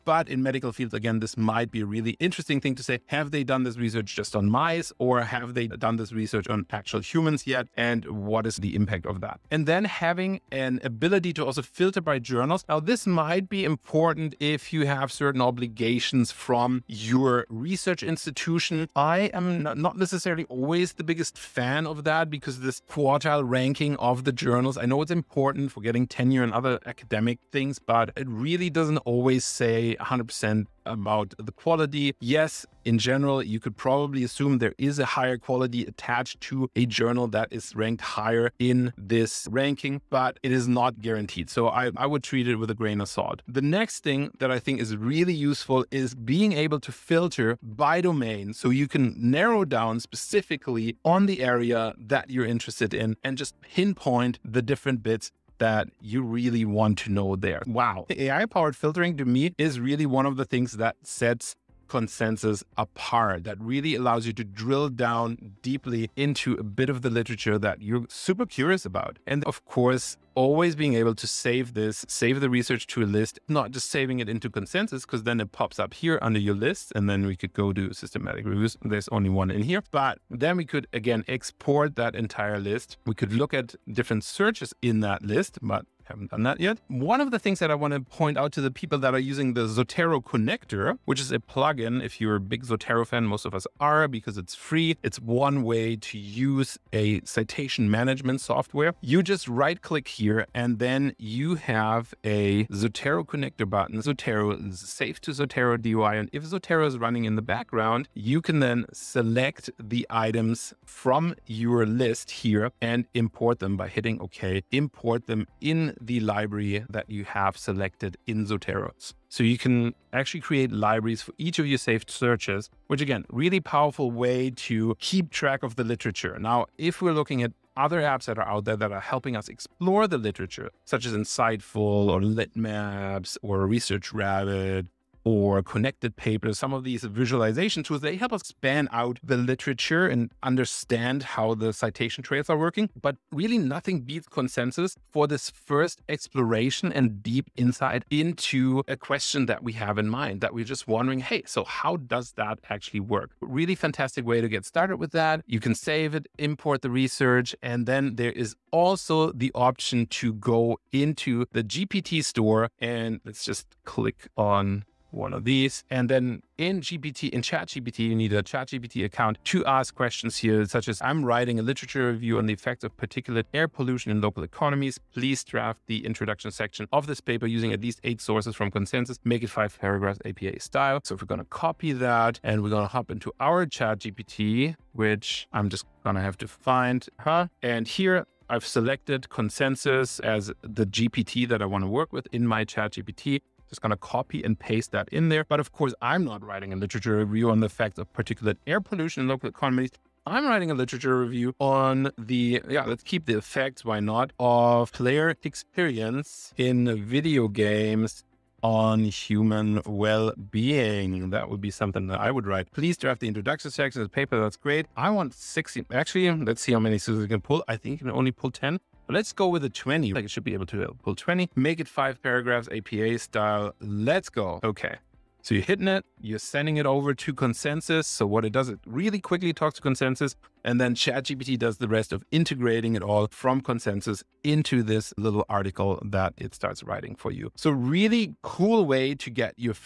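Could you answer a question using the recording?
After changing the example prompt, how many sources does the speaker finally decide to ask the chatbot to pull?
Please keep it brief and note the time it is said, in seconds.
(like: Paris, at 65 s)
20, at 219 s.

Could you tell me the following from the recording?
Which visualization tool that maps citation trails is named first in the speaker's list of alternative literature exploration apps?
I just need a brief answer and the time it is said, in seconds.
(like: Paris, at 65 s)
Inciteful, at 131 s.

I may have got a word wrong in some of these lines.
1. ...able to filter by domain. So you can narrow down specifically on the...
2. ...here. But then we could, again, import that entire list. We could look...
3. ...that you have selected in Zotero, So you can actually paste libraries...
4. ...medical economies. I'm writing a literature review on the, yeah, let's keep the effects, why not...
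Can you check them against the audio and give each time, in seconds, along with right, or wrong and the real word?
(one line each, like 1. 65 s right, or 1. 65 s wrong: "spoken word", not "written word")
1. 46 s right
2. 79 s wrong: "export", not "import"
3. 116 s wrong: "create", not "paste"
4. 199 s wrong: "local", not "medical".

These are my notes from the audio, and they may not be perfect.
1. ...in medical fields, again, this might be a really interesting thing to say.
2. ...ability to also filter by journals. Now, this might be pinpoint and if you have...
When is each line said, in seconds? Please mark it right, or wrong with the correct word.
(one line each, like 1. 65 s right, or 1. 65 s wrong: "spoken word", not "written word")
1. 0 s right
2. 10 s wrong: "important", not "pinpoint".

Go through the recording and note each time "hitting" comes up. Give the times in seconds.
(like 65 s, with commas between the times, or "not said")
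113 s, 225 s.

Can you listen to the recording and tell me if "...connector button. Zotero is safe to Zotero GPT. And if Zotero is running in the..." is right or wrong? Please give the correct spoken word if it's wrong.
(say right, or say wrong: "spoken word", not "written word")
wrong: "DOI", not "GPT".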